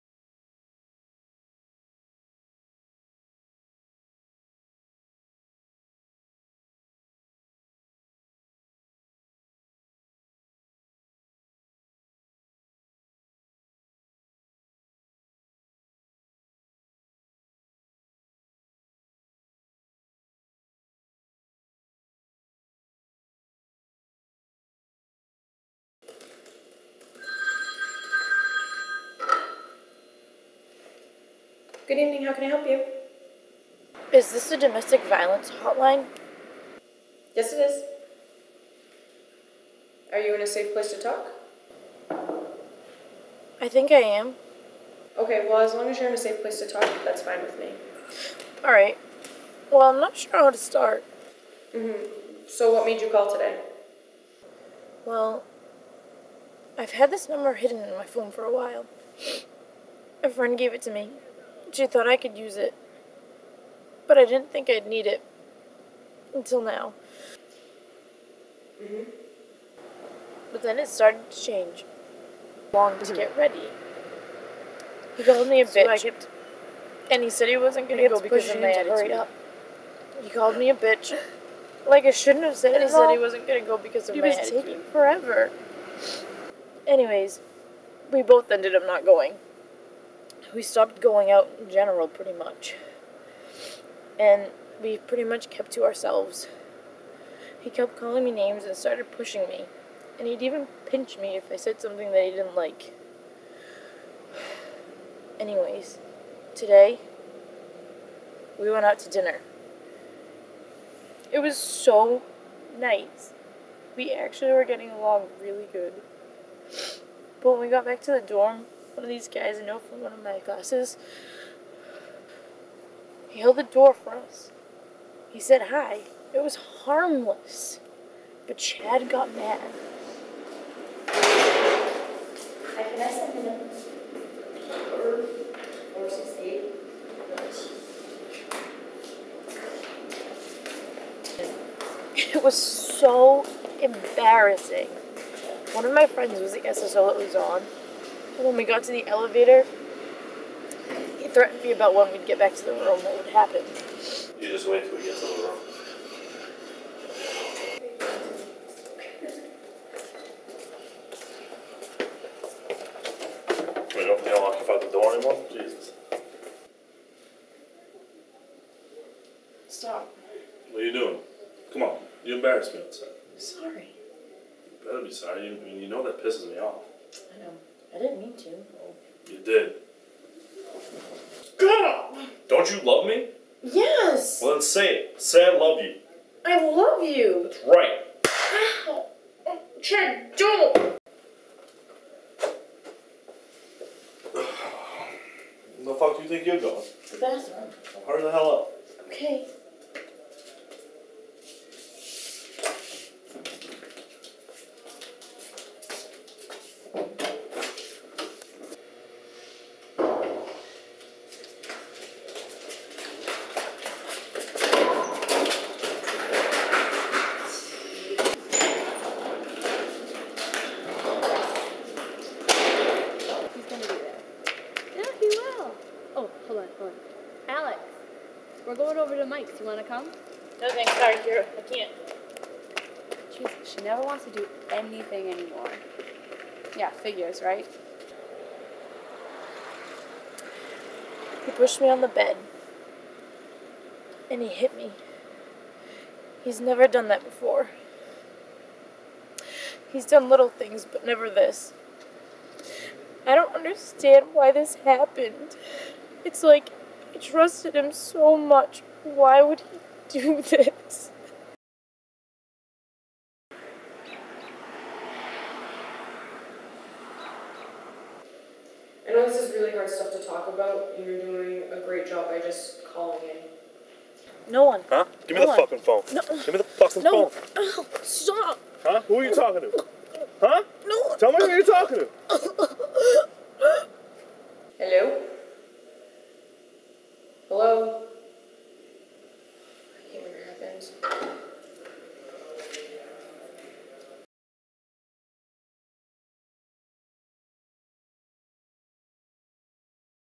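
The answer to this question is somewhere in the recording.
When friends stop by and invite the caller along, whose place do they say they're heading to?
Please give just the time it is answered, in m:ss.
3:49.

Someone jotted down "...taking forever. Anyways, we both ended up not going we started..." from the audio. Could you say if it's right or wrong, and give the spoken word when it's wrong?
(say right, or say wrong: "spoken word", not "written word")
wrong: "stopped", not "started".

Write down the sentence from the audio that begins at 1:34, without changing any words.
And we pretty much kept to ourselves.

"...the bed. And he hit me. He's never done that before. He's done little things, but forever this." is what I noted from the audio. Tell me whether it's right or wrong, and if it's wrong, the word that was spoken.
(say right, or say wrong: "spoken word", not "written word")
wrong: "never", not "forever".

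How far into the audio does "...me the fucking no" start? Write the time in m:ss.
4:36.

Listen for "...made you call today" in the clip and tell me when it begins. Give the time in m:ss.
0:52.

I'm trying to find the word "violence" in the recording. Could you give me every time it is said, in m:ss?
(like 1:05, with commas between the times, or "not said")
0:35.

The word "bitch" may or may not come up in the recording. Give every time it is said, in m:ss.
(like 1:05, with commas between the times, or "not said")
1:15, 1:20.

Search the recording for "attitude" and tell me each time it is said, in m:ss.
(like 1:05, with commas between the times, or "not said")
1:18, 1:24.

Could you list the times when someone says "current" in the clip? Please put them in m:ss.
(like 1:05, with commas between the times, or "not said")
not said.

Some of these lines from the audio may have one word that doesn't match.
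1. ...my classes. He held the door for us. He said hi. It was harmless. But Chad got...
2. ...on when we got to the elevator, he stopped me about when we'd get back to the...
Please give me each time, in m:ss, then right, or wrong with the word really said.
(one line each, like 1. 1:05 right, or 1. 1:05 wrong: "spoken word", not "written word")
1. 2:00 right
2. 2:27 wrong: "threatened", not "stopped".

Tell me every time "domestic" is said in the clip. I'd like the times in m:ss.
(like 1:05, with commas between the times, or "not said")
0:34.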